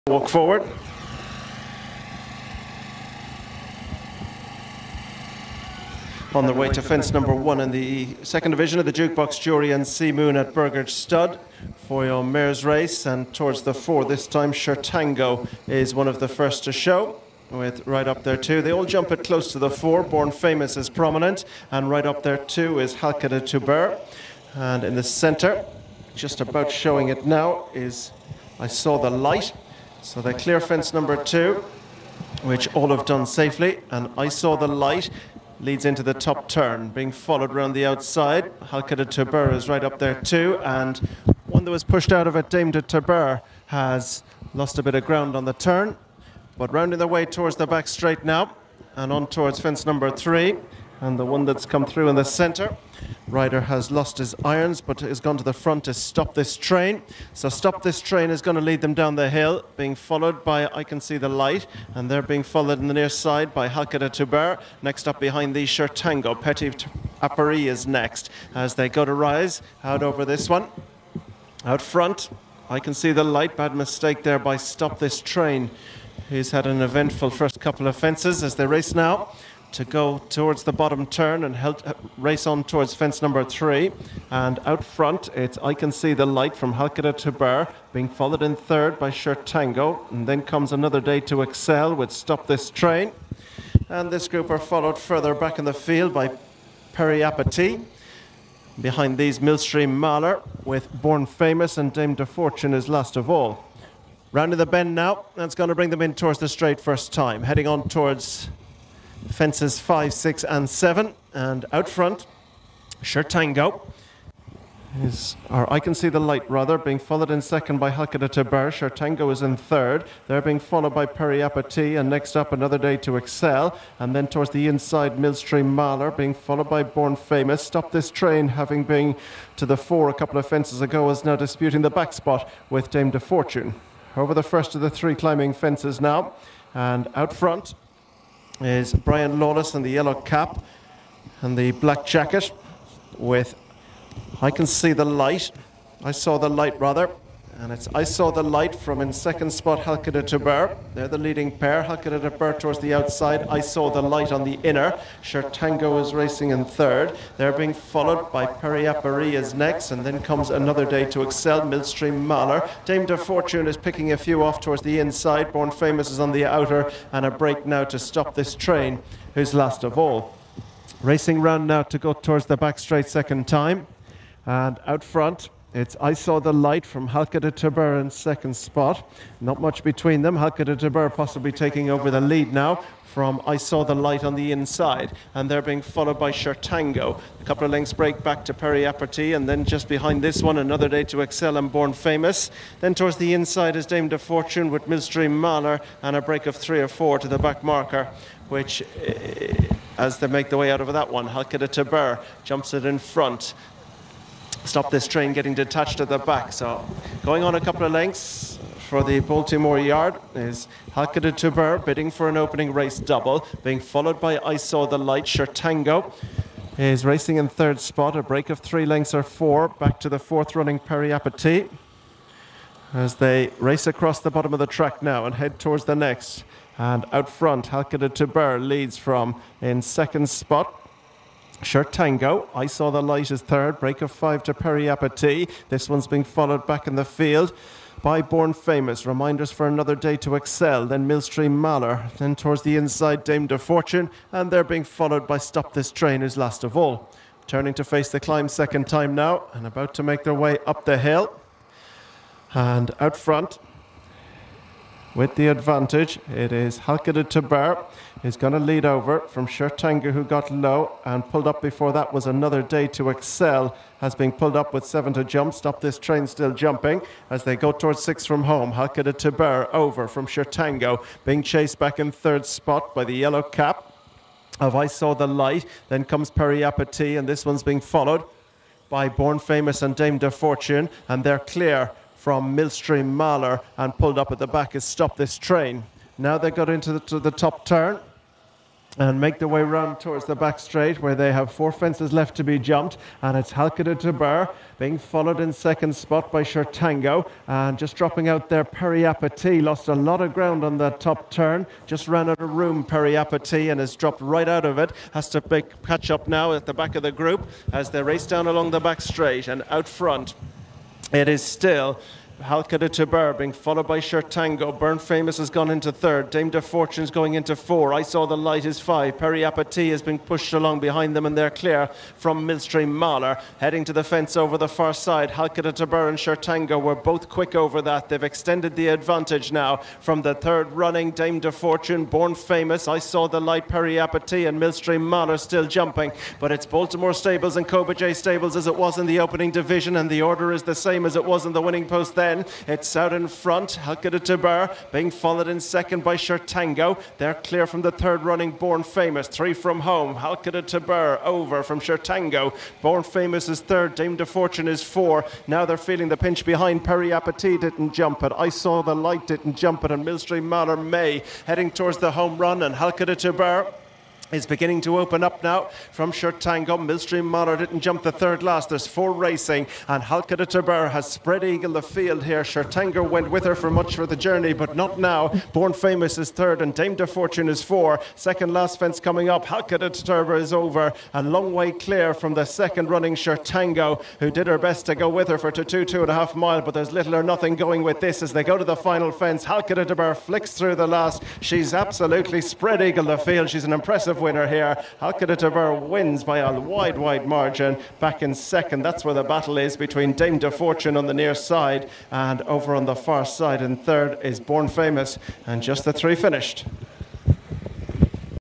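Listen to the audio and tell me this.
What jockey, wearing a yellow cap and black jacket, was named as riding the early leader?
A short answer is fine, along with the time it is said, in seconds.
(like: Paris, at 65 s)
Brian Lawless, at 138 s.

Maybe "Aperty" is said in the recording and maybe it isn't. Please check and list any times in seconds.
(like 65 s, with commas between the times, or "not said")
188 s.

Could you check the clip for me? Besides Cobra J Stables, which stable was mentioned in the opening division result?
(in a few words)
Baltimore Stables.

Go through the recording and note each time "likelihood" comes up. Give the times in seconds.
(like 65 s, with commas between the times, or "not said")
not said.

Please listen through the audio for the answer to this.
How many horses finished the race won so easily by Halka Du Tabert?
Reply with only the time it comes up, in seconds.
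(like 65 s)
405 s.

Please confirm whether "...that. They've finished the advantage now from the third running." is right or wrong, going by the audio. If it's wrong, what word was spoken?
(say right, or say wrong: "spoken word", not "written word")
wrong: "extended", not "finished".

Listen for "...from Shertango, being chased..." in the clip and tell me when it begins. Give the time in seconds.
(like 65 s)
270 s.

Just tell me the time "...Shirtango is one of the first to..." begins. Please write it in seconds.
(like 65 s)
14 s.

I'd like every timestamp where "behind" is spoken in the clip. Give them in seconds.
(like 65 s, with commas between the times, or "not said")
65 s, 98 s, 189 s, 320 s, 356 s.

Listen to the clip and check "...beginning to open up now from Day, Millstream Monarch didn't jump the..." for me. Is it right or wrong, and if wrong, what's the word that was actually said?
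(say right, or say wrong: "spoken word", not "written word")
wrong: "Shertango", not "Day".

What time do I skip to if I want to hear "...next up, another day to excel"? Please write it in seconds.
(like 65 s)
122 s.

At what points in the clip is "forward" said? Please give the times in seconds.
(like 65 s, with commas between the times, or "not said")
0 s.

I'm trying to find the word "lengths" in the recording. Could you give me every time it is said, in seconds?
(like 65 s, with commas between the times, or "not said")
187 s, 207 s, 218 s.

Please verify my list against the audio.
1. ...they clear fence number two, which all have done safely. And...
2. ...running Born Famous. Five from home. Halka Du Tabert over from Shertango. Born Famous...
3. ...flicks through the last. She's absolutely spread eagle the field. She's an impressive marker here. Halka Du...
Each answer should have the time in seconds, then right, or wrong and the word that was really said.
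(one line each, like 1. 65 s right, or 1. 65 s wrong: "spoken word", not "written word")
1. 30 s right
2. 348 s wrong: "Three", not "Five"
3. 390 s wrong: "winner", not "marker".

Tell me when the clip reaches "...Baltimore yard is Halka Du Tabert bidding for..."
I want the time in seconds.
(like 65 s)
209 s.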